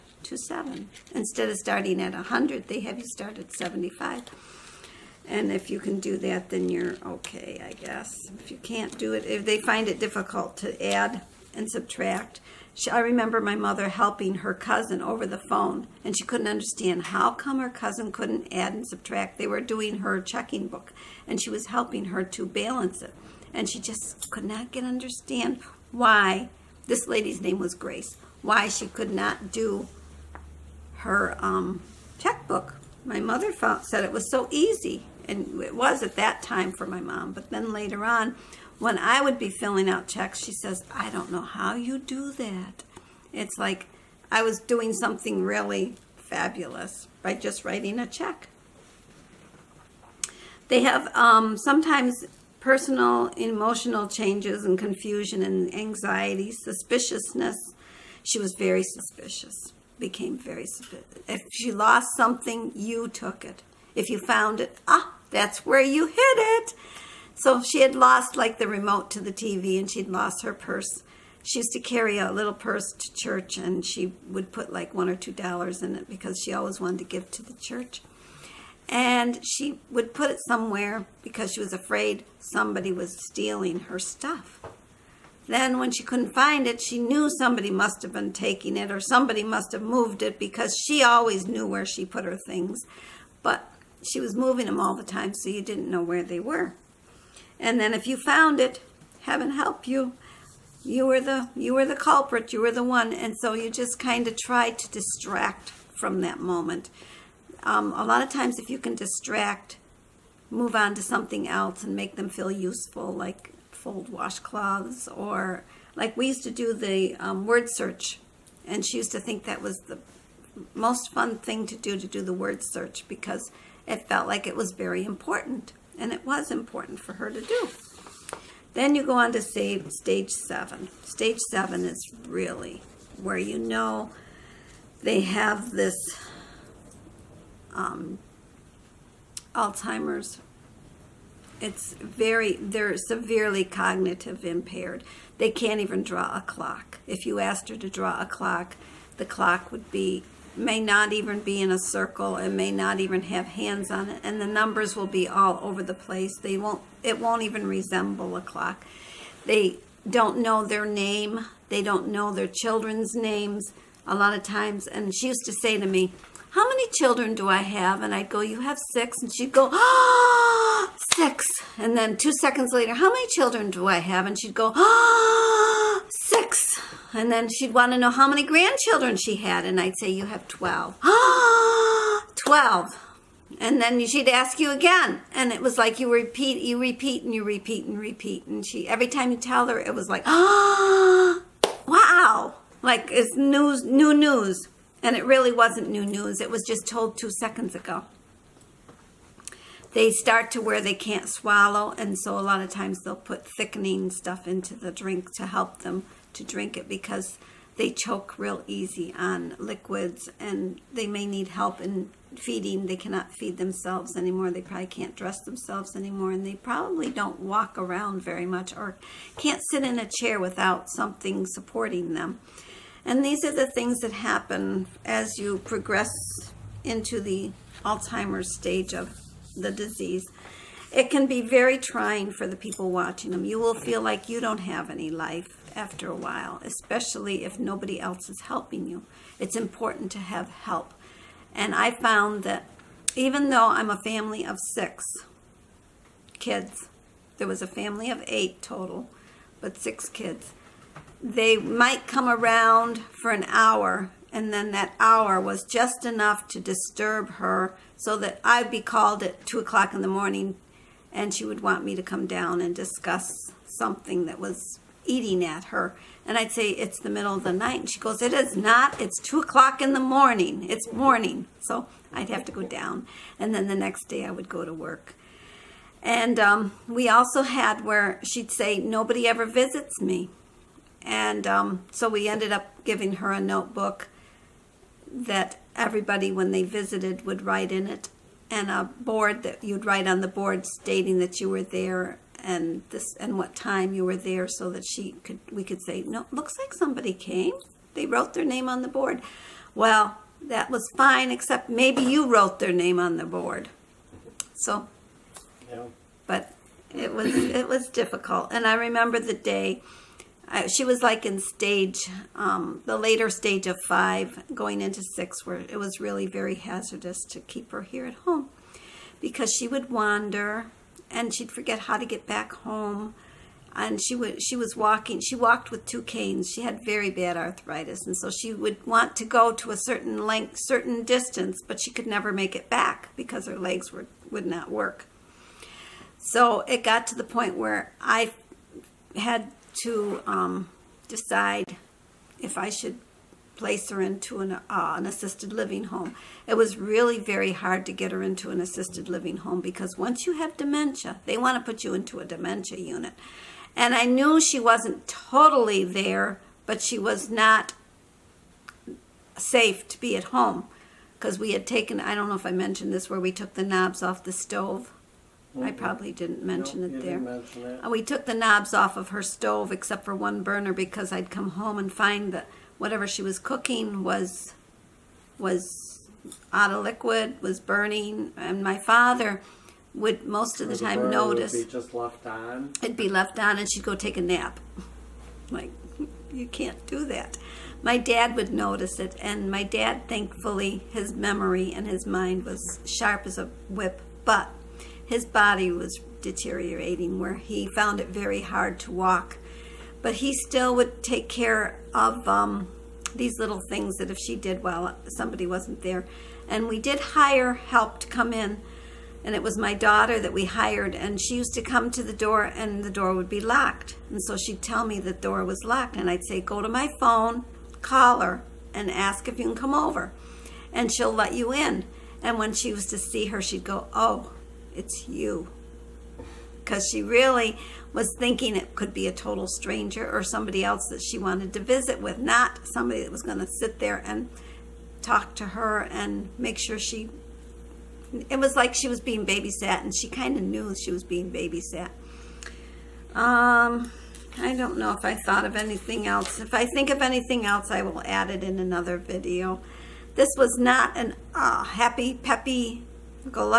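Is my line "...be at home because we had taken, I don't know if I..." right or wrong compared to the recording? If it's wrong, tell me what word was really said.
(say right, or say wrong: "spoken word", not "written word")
right.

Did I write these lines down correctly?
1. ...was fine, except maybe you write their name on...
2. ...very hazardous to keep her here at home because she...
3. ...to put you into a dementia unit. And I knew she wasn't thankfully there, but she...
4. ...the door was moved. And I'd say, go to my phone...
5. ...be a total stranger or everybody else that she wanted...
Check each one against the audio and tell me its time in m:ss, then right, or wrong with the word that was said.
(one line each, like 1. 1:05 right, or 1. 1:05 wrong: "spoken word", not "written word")
1. 5:00 wrong: "wrote", not "write"
2. 5:16 right
3. 5:51 wrong: "totally", not "thankfully"
4. 6:54 wrong: "locked", not "moved"
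5. 7:08 wrong: "somebody", not "everybody".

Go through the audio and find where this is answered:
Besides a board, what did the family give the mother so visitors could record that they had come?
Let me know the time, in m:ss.
4:43.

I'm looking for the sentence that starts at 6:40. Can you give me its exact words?
But he still would take care of um, these little things that if she did well, somebody wasn't there.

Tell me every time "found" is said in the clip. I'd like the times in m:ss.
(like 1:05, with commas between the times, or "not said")
0:33, 1:04, 1:38, 4:01, 6:37.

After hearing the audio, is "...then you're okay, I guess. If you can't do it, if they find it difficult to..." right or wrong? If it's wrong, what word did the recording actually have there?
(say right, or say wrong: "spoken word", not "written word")
right.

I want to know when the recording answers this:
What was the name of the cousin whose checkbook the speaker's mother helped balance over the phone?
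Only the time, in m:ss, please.
0:27.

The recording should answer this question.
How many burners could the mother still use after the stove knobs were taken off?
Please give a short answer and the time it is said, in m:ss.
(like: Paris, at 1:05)
One burner, at 6:10.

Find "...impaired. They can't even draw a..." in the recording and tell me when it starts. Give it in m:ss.
2:24.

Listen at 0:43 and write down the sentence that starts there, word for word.
It's like I was doing something really fabulous by just writing a check.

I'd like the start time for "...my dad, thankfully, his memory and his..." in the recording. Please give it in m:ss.
6:29.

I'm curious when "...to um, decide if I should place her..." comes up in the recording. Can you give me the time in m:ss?
5:39.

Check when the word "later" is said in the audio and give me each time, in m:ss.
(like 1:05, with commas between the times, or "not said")
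0:37, 2:52, 5:12.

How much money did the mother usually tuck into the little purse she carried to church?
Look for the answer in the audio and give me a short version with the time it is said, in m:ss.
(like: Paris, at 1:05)
1 or 2 dollars, at 1:14.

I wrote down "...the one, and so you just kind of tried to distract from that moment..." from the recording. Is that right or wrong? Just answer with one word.
right.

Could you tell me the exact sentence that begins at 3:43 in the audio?
And these are the things that happen as you progress into the Alzheimer's stage of the disease.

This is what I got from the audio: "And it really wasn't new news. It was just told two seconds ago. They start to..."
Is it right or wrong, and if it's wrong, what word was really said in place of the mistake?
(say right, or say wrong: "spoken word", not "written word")
right.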